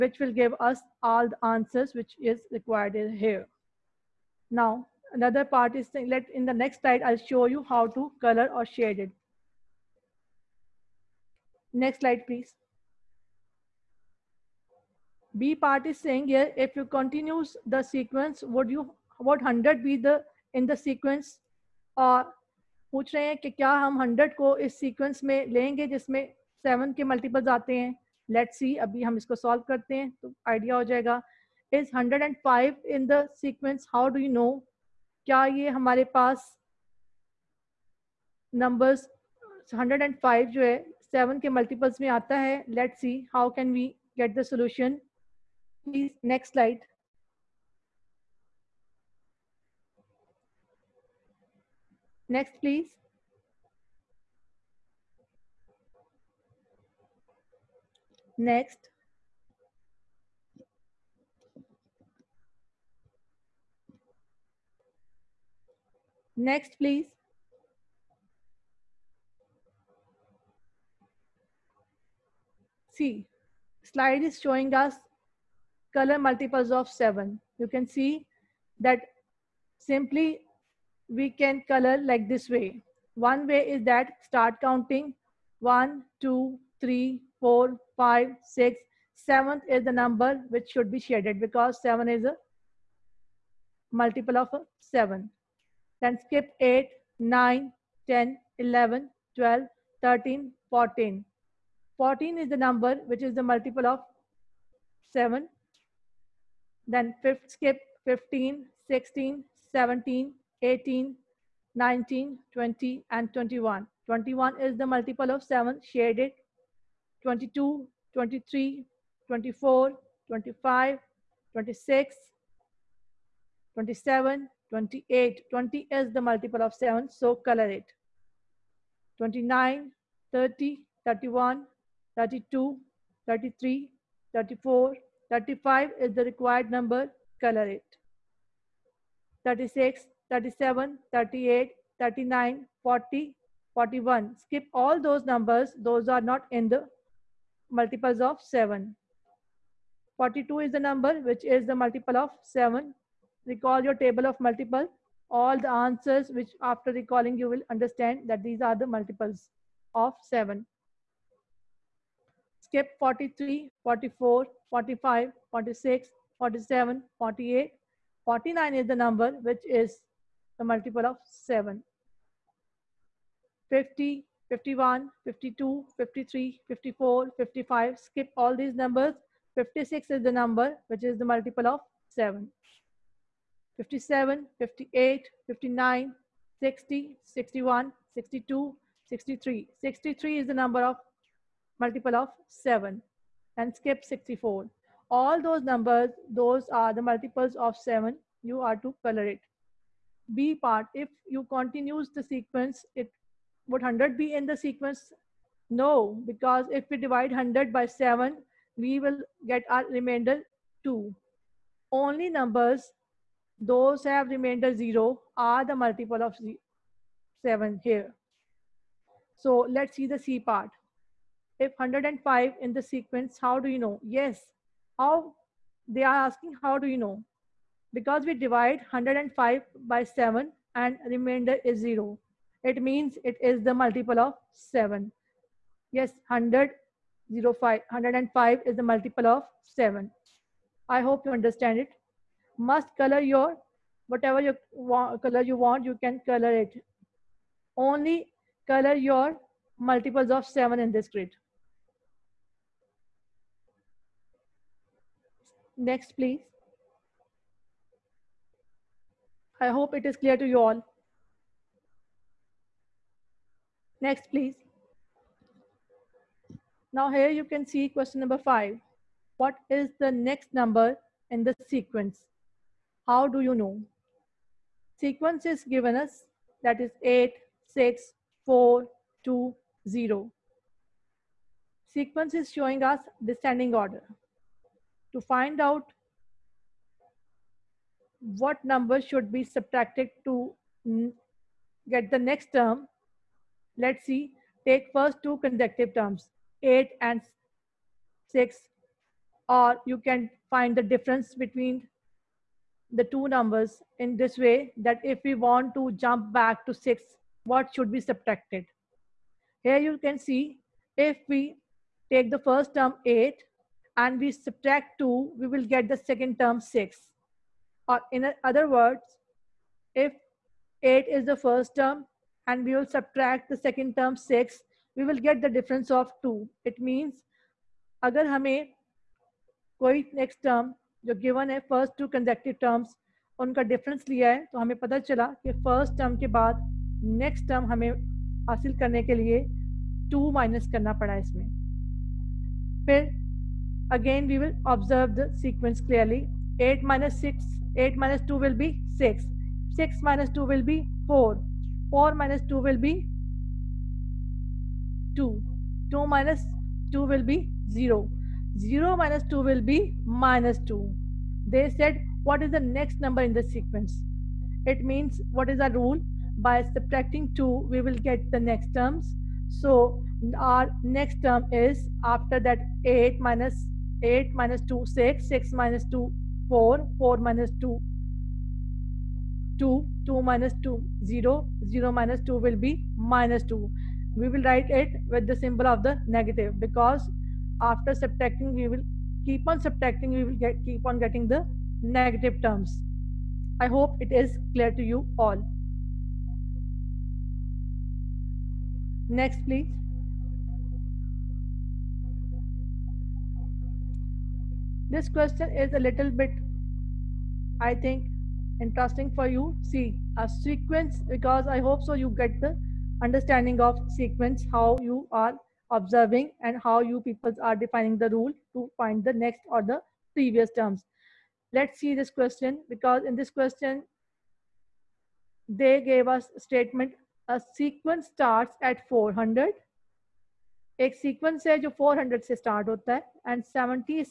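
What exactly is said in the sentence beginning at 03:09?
63 is the number of multiple of 7 and skip 64.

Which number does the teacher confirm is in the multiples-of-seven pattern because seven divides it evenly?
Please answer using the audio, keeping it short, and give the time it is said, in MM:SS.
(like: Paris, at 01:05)
105, at 03:57.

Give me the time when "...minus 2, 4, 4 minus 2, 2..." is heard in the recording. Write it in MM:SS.
06:15.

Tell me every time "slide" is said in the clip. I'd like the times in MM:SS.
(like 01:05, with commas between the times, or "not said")
00:06, 00:11, 01:13.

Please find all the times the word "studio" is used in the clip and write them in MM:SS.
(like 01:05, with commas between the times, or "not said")
not said.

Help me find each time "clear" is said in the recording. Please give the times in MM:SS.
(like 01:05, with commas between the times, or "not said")
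04:20, 06:34.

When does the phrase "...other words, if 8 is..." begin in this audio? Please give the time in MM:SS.
05:18.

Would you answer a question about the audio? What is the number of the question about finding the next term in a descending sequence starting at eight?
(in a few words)
5.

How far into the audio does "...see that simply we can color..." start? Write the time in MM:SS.
01:17.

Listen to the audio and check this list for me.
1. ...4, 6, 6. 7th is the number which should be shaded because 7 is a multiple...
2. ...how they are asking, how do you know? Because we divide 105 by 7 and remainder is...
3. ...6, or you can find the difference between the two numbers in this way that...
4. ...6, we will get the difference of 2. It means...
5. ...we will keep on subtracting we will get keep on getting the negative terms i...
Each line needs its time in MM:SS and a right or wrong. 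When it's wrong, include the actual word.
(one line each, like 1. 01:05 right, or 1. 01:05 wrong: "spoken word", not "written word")
1. 01:27 wrong: "5", not "6"
2. 03:44 right
3. 04:58 right
4. 05:24 right
5. 06:28 right.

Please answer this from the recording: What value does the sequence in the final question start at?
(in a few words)
400.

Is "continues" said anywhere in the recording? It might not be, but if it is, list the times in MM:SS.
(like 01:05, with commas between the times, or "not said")
00:16, 03:21.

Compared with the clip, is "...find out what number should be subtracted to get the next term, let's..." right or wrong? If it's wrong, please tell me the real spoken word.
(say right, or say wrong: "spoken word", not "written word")
right.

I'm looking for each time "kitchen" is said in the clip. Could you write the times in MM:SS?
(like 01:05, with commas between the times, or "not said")
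not said.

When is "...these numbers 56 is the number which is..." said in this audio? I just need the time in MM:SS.
02:58.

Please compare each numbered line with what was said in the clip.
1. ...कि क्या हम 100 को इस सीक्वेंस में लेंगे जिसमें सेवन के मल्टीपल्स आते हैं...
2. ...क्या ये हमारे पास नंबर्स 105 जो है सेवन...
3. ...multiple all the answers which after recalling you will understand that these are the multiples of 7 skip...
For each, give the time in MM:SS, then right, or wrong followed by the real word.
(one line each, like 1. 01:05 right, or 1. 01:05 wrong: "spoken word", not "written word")
1. 00:23 right
2. 00:35 right
3. 02:34 right.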